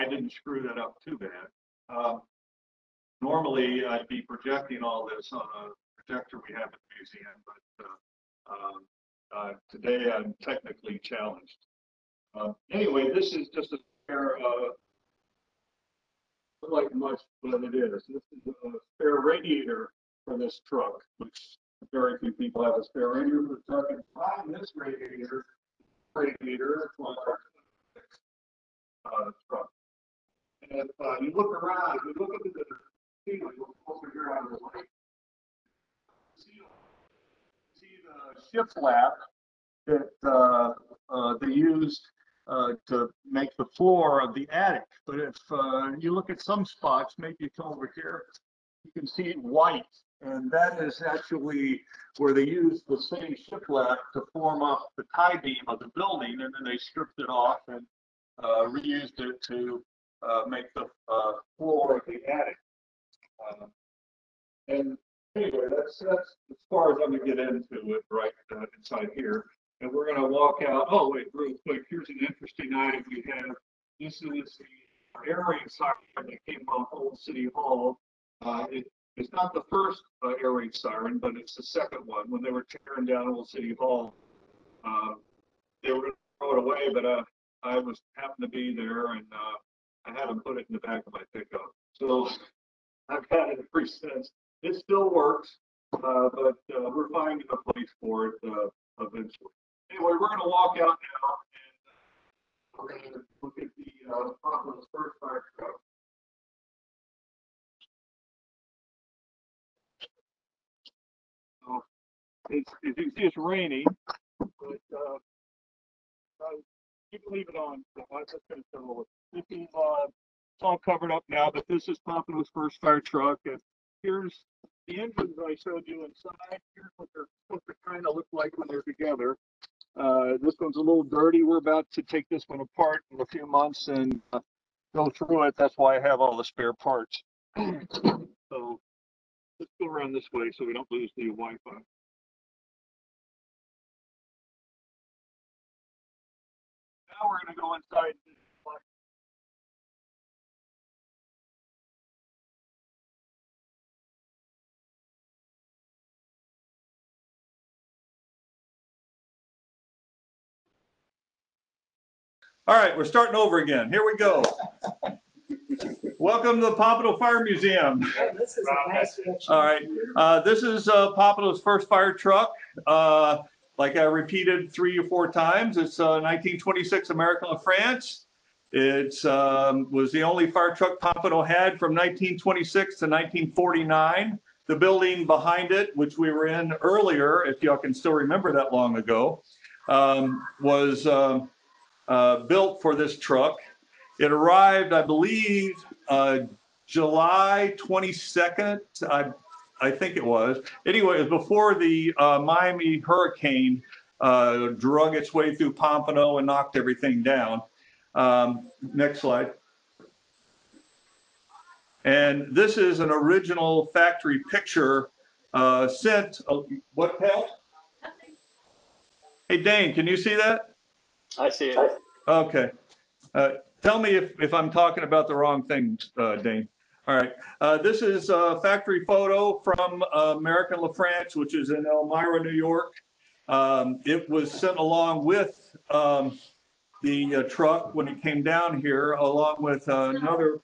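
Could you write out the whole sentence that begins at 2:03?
And here's the engines I showed you inside.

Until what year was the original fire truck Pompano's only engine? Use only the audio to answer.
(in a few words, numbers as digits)
1949.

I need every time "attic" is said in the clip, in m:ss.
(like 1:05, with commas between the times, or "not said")
0:44, 1:02.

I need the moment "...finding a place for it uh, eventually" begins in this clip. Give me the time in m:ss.
1:37.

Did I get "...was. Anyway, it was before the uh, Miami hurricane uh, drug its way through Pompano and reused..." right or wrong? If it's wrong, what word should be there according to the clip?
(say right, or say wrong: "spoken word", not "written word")
wrong: "knocked", not "reused".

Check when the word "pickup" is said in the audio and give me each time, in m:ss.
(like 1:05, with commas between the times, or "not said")
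1:31.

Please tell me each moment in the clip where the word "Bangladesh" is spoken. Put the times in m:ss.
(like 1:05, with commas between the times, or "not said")
not said.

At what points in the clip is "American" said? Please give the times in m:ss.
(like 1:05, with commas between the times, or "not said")
2:57, 3:50.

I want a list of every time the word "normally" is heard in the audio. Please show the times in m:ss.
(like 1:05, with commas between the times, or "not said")
0:03.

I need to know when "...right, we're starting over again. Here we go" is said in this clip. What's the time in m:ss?
2:42.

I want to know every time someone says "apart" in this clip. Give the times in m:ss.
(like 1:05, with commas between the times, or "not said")
2:12.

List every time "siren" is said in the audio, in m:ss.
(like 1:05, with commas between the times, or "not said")
1:15, 1:20.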